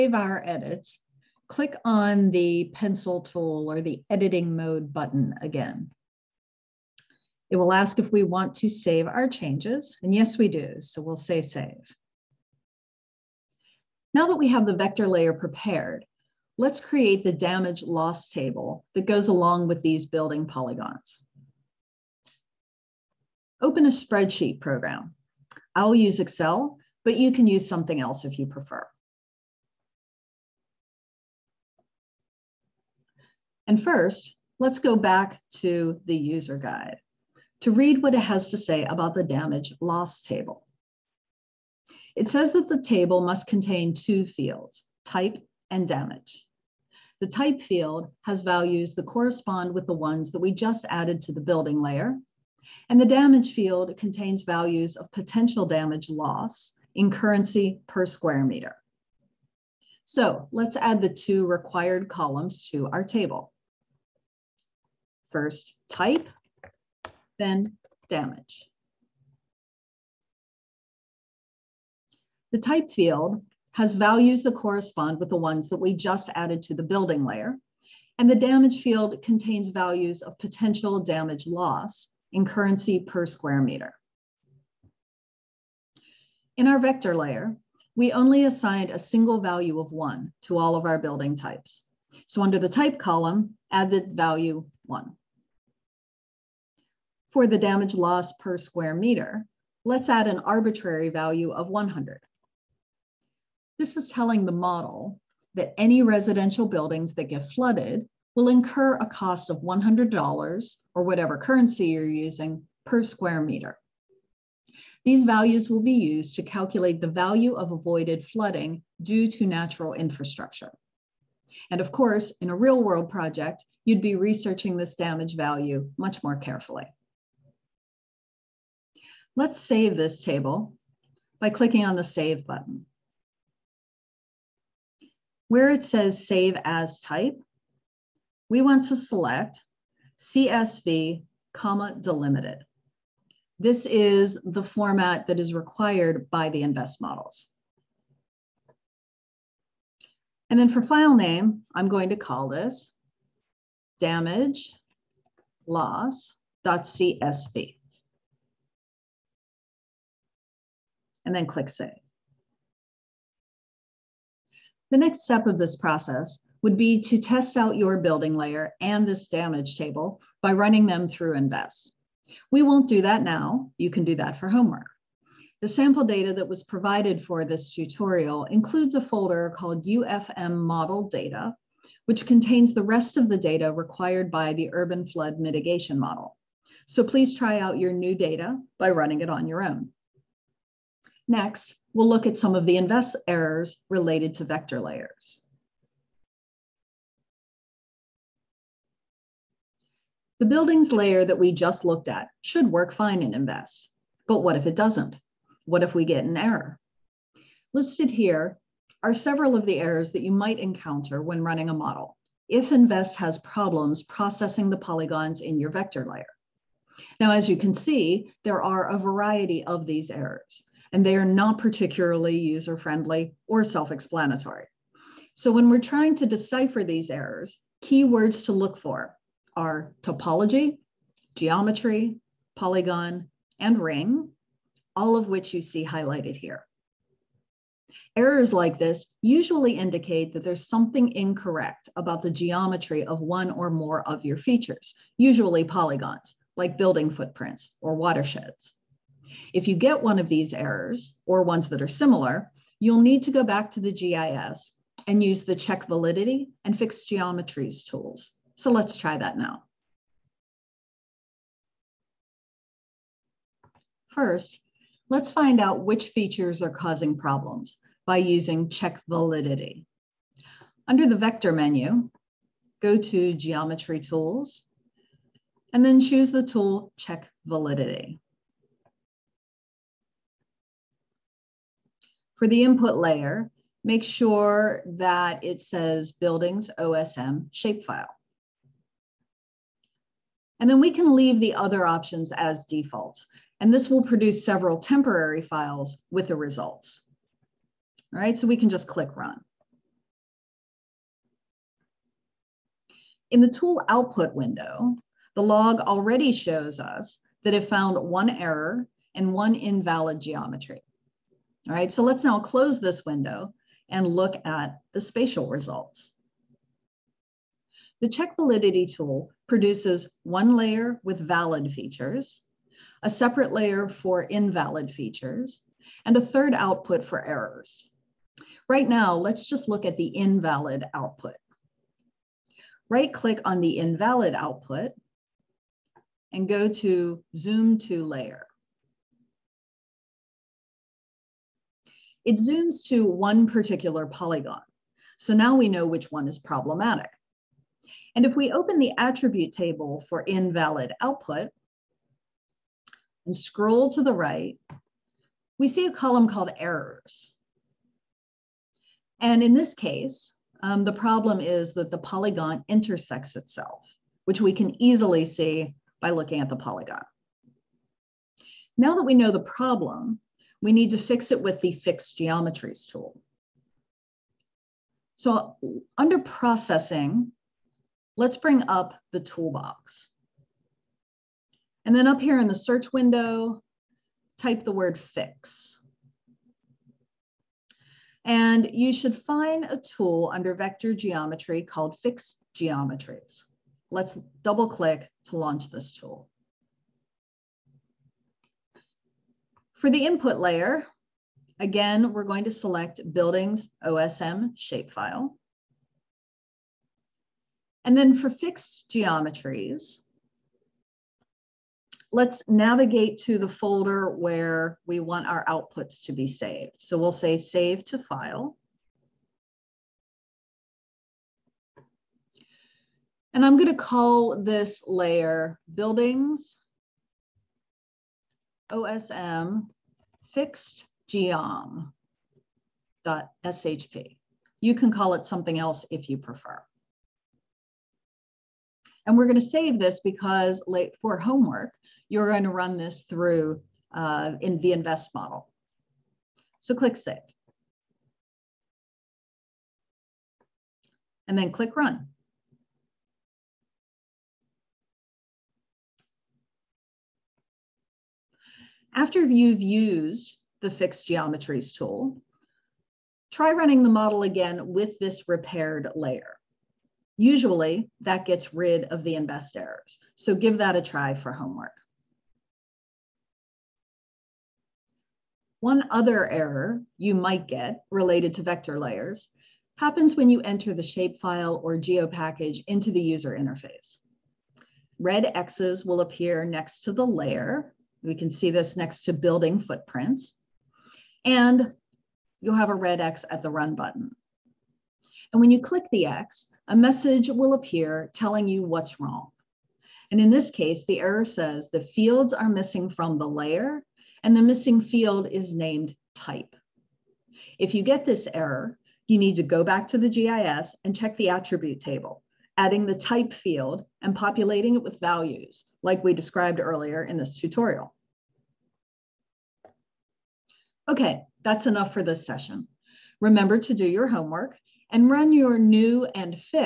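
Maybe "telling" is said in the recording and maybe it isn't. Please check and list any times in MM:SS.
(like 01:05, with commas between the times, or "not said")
01:44, 08:18.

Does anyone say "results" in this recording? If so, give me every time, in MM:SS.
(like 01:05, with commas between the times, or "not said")
04:56, 05:15.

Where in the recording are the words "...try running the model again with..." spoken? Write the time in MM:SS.
07:43.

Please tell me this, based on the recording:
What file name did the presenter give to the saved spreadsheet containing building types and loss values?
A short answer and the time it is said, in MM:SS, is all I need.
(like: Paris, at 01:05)
damage loss.csv, at 02:33.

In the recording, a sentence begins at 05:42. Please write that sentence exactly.
It zooms to one particular polygon.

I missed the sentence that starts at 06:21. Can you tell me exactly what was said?
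And then up here in the search window, type the word fix.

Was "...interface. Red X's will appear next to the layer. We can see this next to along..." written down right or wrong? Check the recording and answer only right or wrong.
wrong.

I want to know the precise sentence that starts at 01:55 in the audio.
These values will be used to calculate the value of avoided flooding due to natural infrastructure.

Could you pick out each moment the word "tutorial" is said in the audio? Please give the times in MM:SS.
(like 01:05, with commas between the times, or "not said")
02:57, 08:37.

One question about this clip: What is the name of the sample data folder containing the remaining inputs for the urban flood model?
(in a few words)
UFM model data.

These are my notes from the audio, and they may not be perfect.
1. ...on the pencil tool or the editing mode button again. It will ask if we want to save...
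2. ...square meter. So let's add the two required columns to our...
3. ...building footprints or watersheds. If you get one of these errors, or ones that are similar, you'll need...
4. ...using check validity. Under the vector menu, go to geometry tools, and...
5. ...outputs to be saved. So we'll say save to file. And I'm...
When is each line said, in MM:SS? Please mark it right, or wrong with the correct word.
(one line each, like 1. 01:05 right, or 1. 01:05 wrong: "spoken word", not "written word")
1. 00:01 right
2. 00:58 right
3. 04:06 right
4. 04:28 right
5. 06:55 right.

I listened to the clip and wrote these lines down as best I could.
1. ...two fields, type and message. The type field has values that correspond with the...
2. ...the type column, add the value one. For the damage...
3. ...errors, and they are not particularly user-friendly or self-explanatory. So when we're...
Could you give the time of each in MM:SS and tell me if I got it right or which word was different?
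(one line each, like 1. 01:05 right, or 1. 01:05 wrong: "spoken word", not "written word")
1. 00:43 wrong: "damage", not "message"
2. 01:32 right
3. 03:40 right.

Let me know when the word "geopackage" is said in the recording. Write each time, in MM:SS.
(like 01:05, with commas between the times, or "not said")
08:01.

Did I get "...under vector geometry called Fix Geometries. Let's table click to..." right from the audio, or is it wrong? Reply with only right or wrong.
wrong.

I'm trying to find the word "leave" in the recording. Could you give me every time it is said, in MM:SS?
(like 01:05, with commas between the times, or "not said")
04:51.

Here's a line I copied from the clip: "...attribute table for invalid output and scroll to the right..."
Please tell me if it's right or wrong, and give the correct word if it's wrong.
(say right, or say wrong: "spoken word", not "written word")
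right.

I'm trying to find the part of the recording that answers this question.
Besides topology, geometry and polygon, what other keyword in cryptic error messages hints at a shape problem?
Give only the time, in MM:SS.
03:53.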